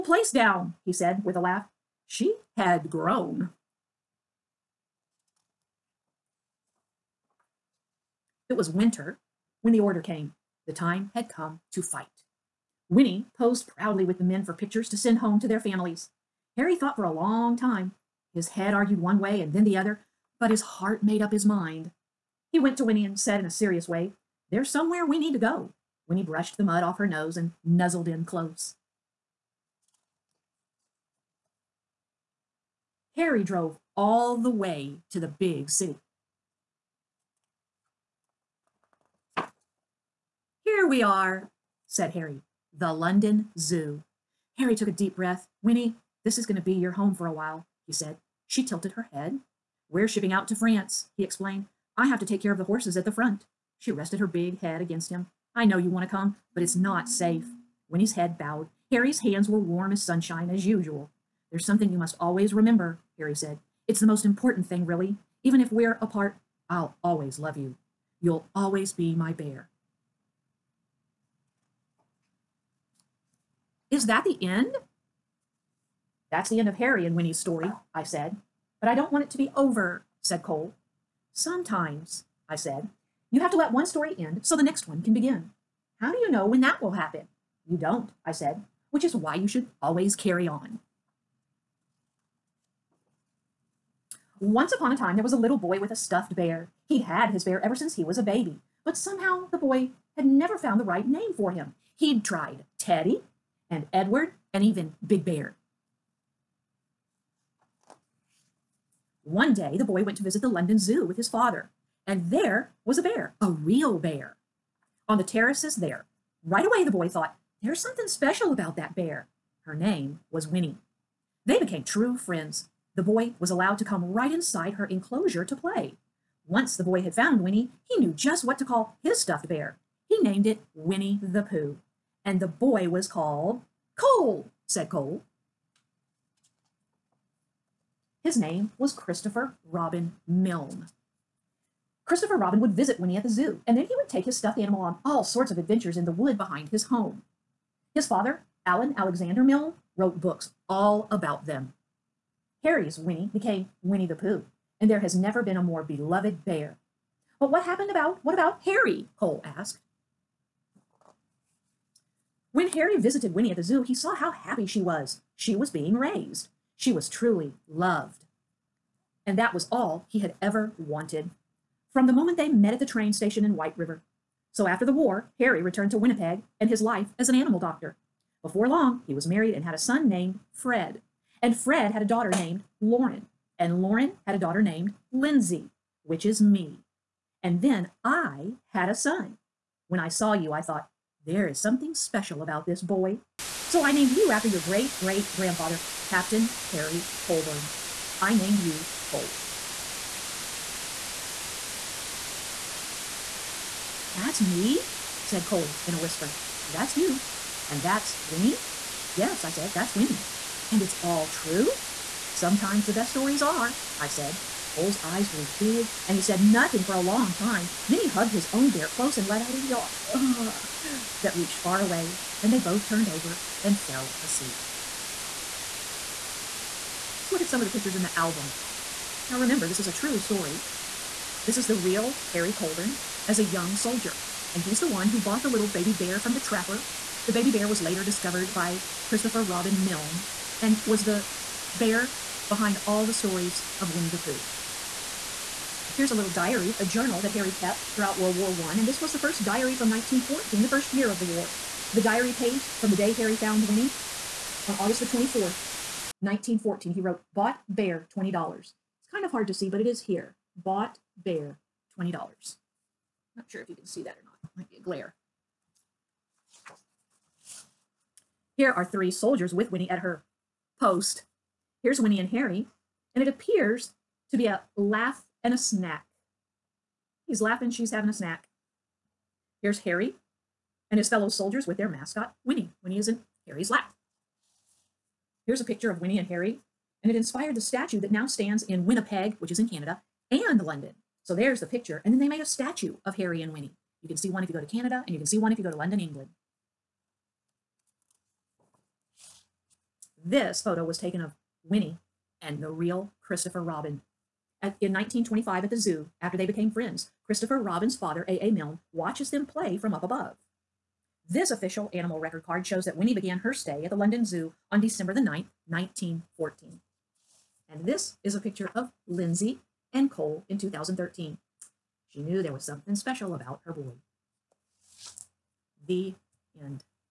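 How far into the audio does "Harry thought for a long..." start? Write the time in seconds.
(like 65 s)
16 s.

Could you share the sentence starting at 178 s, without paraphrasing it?
Before long, he was married and had a son named Fred.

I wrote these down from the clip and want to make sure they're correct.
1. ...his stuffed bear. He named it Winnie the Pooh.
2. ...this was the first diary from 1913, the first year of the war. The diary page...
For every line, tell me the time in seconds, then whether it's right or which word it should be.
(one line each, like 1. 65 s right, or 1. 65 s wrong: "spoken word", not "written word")
1. 129 s right
2. 248 s wrong: "1914", not "1913".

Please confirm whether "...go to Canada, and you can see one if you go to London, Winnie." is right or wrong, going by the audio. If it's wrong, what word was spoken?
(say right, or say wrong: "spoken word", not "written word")
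wrong: "England", not "Winnie".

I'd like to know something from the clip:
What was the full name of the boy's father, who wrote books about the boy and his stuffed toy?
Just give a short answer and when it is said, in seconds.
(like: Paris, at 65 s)
Alan Alexander Milne, at 148 s.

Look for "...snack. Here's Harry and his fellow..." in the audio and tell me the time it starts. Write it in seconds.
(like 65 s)
278 s.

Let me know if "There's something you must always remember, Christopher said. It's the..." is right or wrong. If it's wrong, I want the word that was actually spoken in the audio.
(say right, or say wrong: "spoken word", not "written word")
wrong: "Harry", not "Christopher".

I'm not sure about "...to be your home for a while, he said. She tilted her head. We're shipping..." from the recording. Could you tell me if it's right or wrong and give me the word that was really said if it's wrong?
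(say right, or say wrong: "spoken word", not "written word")
right.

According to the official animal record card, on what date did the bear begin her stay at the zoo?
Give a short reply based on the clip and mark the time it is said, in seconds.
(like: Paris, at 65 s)
December 9, 1914, at 314 s.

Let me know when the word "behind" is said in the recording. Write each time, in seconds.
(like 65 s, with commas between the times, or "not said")
146 s, 242 s.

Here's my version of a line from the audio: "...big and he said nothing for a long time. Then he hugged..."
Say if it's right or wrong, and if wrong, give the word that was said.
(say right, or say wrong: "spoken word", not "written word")
right.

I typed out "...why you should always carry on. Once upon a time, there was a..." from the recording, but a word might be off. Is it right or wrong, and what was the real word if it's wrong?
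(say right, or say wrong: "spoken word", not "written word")
right.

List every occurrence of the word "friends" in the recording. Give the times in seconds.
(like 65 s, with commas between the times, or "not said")
122 s, 306 s.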